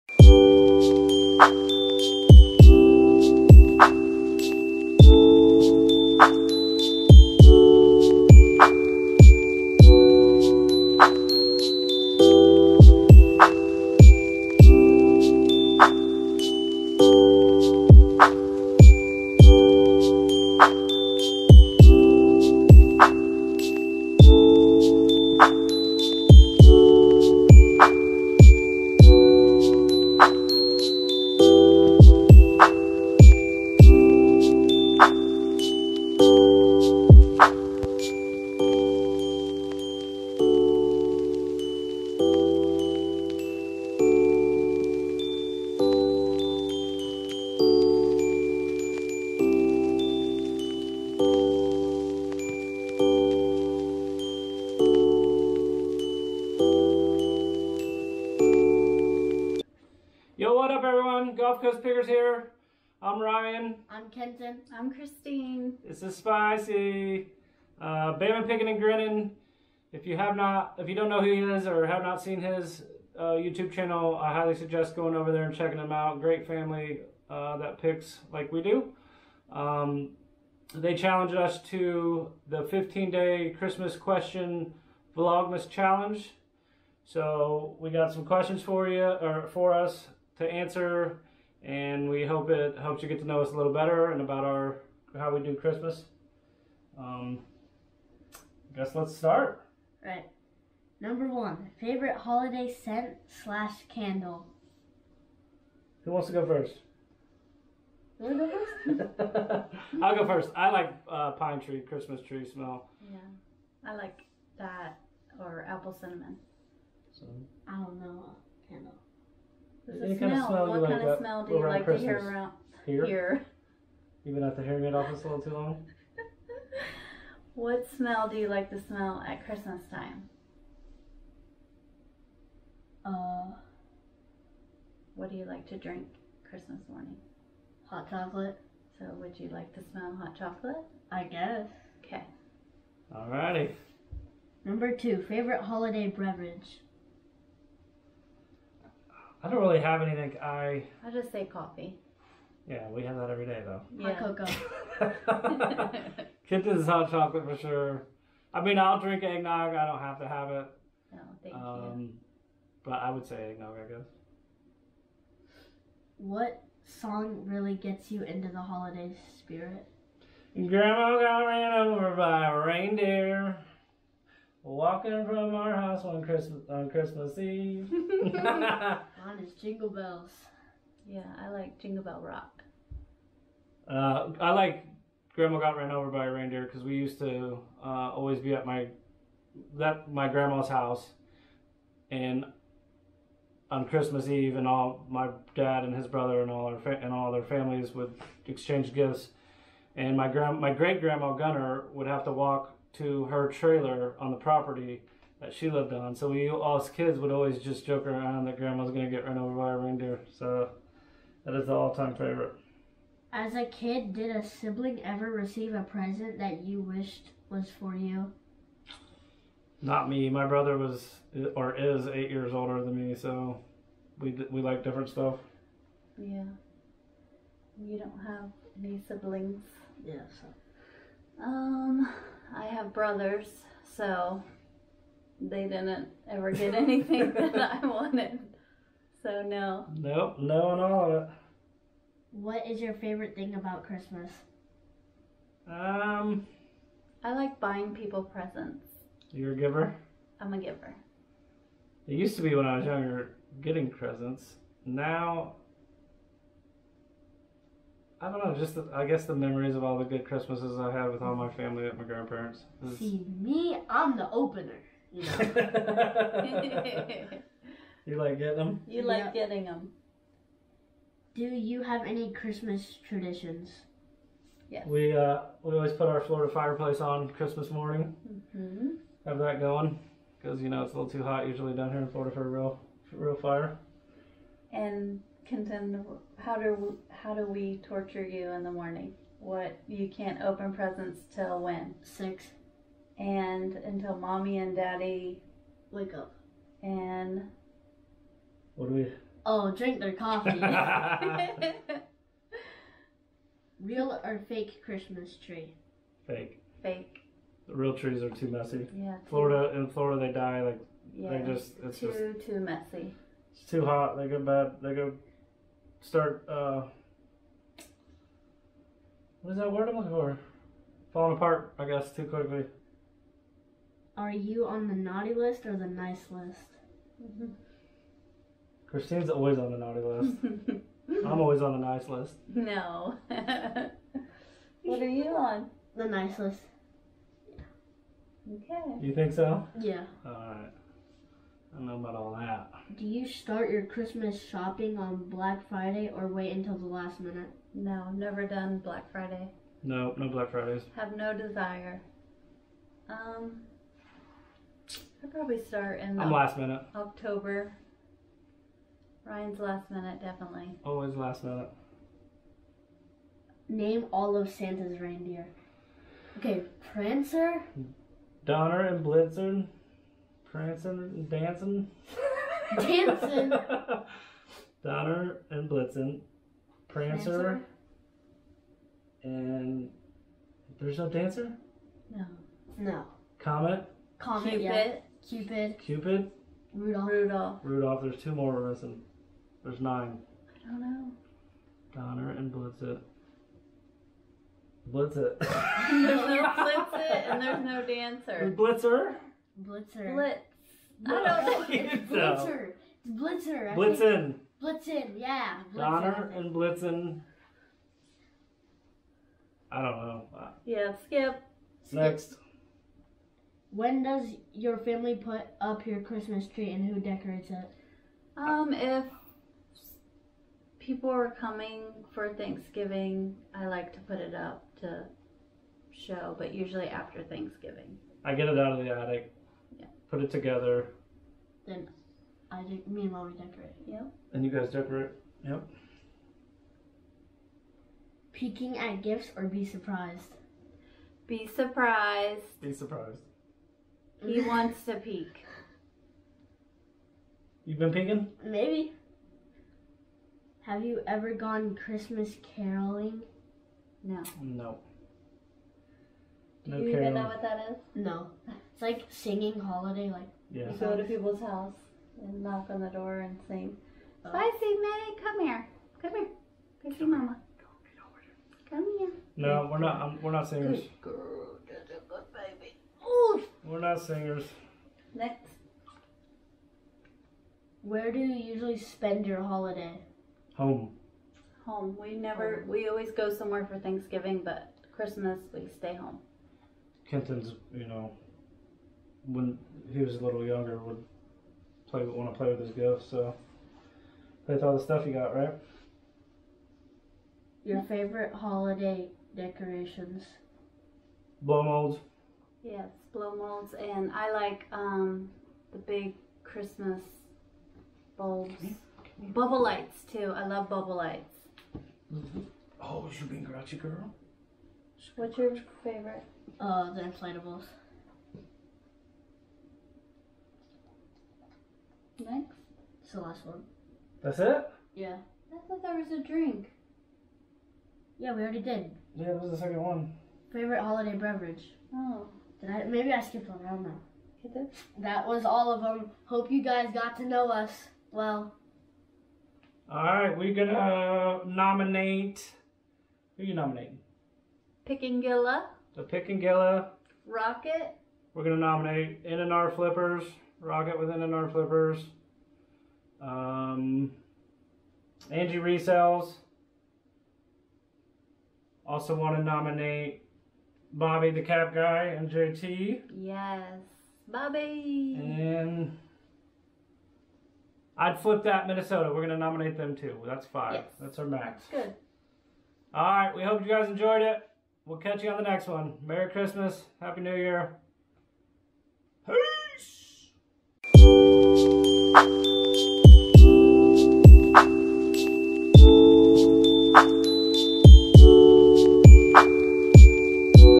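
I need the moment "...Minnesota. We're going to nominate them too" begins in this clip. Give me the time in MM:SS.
09:28.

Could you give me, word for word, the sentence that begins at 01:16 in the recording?
Great family uh, that picks like we do.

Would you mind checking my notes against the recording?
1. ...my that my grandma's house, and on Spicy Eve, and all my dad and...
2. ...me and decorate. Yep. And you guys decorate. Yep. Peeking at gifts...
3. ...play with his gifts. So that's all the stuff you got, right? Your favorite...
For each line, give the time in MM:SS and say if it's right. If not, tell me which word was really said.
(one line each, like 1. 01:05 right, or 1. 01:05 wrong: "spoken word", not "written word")
1. 03:08 wrong: "Christmas", not "Spicy"
2. 07:12 right
3. 08:12 right.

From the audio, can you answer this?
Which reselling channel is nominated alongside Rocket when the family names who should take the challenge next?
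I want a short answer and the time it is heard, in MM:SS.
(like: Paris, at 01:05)
N and R Flippers, at 09:09.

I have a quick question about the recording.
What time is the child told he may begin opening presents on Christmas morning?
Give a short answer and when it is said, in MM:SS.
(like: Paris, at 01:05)
6, at 04:52.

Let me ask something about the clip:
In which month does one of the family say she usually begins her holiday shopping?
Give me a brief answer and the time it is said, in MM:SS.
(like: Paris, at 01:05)
October, at 05:56.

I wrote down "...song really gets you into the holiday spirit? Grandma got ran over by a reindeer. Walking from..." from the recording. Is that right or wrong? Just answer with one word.
right.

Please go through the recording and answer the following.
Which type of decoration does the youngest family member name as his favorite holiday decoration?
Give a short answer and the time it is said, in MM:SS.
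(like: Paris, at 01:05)
Inflatables, at 08:36.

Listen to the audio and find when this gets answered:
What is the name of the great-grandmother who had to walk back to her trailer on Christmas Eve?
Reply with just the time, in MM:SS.
03:20.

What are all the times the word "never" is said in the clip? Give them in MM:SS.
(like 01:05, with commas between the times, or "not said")
05:48, 08:02.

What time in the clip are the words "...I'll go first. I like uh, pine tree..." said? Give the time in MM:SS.
01:48.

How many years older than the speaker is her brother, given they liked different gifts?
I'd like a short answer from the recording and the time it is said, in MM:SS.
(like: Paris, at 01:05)
8, at 03:42.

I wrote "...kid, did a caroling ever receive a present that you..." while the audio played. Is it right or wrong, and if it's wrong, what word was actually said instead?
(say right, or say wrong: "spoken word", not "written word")
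wrong: "sibling", not "caroling".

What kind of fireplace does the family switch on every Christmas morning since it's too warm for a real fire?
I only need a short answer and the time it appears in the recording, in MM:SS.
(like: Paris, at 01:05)
Florida fireplace, at 04:36.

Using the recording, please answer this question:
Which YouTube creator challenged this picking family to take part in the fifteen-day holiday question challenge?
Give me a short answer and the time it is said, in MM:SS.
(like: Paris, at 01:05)
Bama Picking and Grinning, at 01:08.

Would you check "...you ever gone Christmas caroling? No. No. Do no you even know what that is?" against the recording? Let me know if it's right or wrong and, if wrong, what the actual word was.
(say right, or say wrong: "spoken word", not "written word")
right.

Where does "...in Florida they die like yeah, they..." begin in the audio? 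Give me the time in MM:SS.
05:09.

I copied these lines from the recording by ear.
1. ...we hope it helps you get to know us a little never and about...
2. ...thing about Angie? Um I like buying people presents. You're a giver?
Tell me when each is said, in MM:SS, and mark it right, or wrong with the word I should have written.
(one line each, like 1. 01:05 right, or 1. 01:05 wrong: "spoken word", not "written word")
1. 01:32 wrong: "better", not "never"
2. 04:03 wrong: "Christmas", not "Angie".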